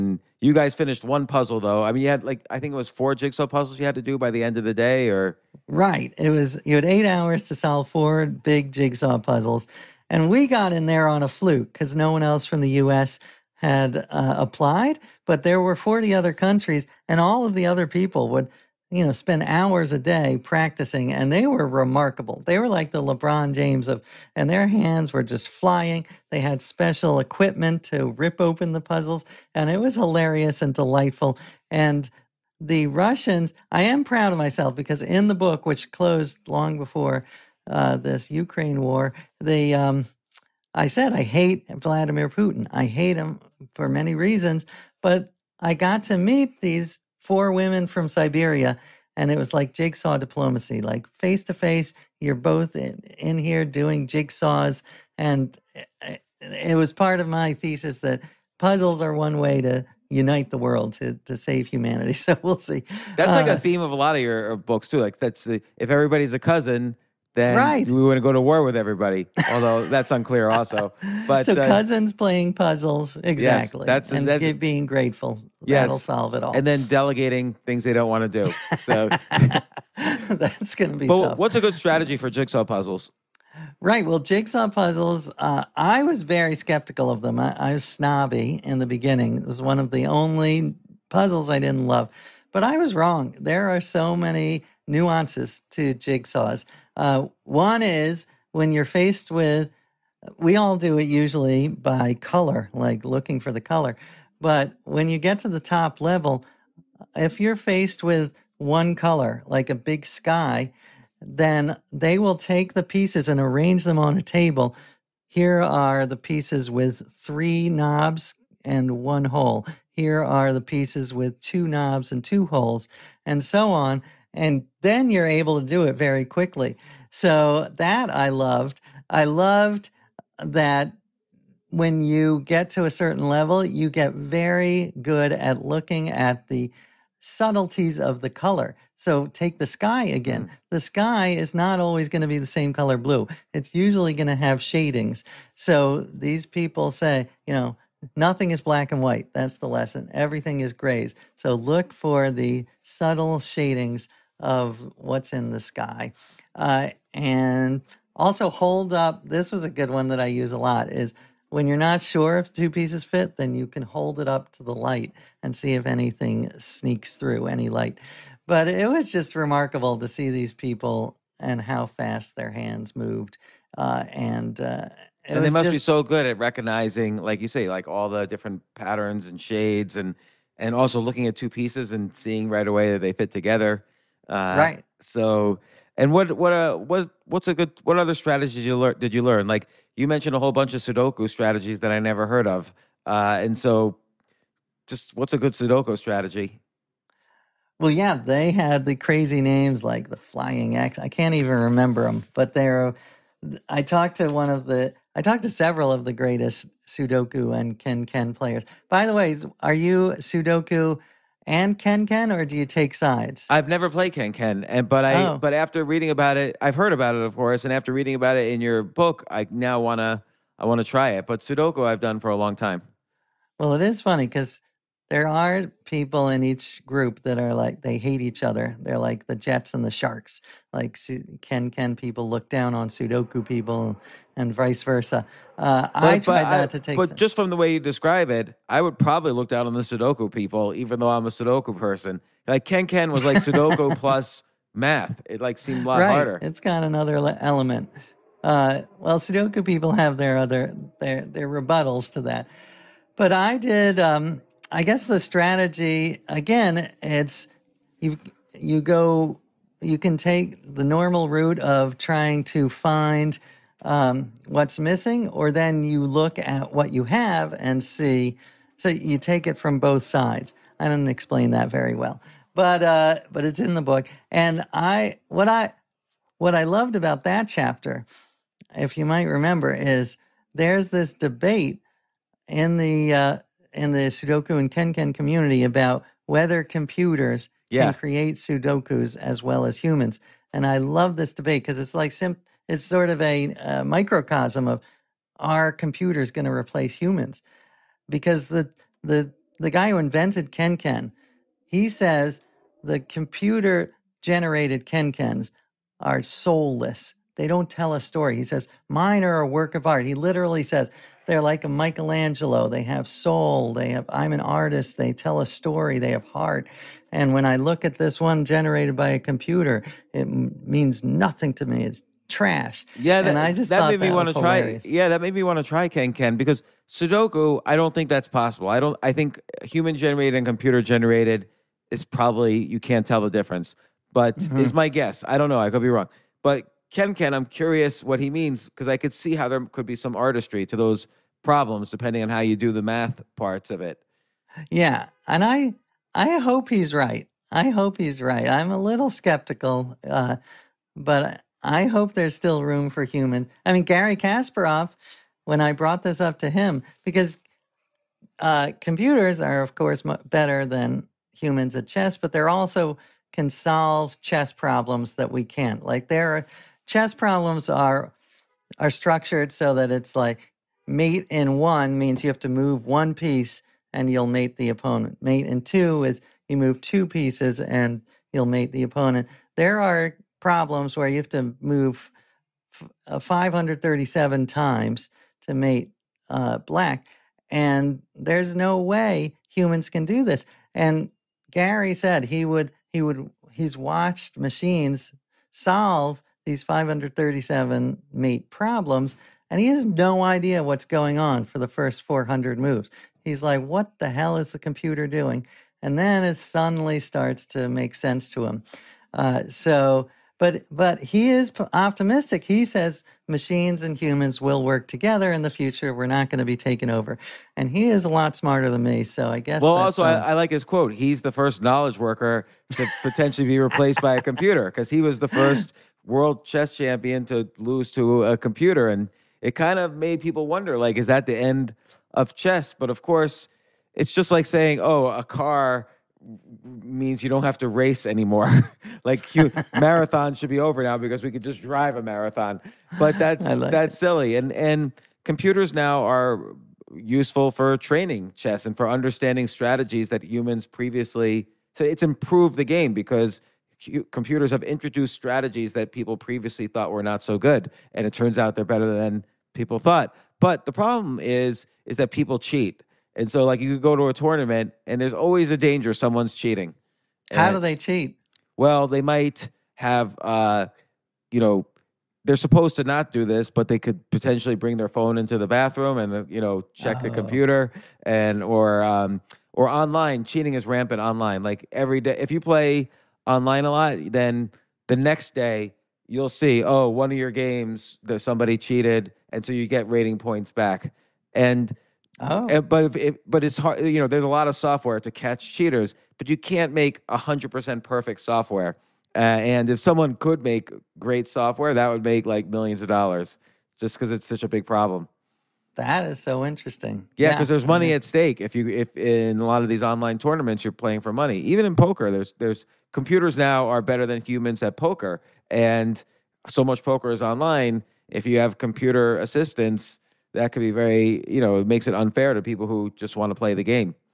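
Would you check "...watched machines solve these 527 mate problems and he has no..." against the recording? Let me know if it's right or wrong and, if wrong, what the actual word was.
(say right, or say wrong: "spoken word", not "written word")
wrong: "537", not "527".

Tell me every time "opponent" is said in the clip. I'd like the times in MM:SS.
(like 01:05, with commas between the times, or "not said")
06:14, 06:18.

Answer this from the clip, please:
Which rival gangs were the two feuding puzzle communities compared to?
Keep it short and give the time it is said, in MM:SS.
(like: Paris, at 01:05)
the Jets and the Sharks, at 03:49.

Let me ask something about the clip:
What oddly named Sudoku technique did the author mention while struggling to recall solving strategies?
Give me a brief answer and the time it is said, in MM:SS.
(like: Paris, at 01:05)
Flying X, at 03:20.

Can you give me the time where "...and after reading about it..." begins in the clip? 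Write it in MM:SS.
03:37.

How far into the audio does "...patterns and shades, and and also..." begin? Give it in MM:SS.
02:58.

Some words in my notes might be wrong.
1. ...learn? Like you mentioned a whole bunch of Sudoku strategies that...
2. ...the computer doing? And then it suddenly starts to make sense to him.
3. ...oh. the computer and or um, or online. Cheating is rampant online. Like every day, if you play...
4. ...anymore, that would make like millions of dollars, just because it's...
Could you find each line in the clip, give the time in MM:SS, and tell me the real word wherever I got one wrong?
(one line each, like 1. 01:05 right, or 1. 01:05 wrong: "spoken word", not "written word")
1. 03:09 right
2. 06:44 right
3. 07:56 right
4. 08:21 wrong: "software", not "anymore".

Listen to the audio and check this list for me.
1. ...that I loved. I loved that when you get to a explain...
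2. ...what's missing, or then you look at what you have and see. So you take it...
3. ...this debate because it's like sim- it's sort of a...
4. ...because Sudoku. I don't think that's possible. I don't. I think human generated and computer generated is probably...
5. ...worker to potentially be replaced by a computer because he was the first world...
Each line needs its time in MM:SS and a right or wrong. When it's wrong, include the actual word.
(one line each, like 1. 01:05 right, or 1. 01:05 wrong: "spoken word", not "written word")
1. 02:07 wrong: "certain", not "explain"
2. 04:24 right
3. 04:51 right
4. 05:26 right
5. 07:01 right.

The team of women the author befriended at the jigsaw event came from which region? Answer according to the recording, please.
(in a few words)
Siberia.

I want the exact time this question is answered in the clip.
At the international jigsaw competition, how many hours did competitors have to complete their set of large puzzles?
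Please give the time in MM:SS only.
00:06.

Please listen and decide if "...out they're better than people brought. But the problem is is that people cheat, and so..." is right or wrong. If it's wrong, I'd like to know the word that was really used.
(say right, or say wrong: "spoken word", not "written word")
wrong: "thought", not "brought".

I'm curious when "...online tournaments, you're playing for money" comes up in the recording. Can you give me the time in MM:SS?
08:29.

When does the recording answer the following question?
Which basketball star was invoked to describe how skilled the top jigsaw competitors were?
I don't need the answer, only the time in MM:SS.
00:23.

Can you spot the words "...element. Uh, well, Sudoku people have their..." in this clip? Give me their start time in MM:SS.
04:07.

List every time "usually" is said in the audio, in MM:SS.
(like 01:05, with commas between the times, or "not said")
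01:41, 02:23.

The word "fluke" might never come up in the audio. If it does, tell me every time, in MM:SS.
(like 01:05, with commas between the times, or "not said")
00:11.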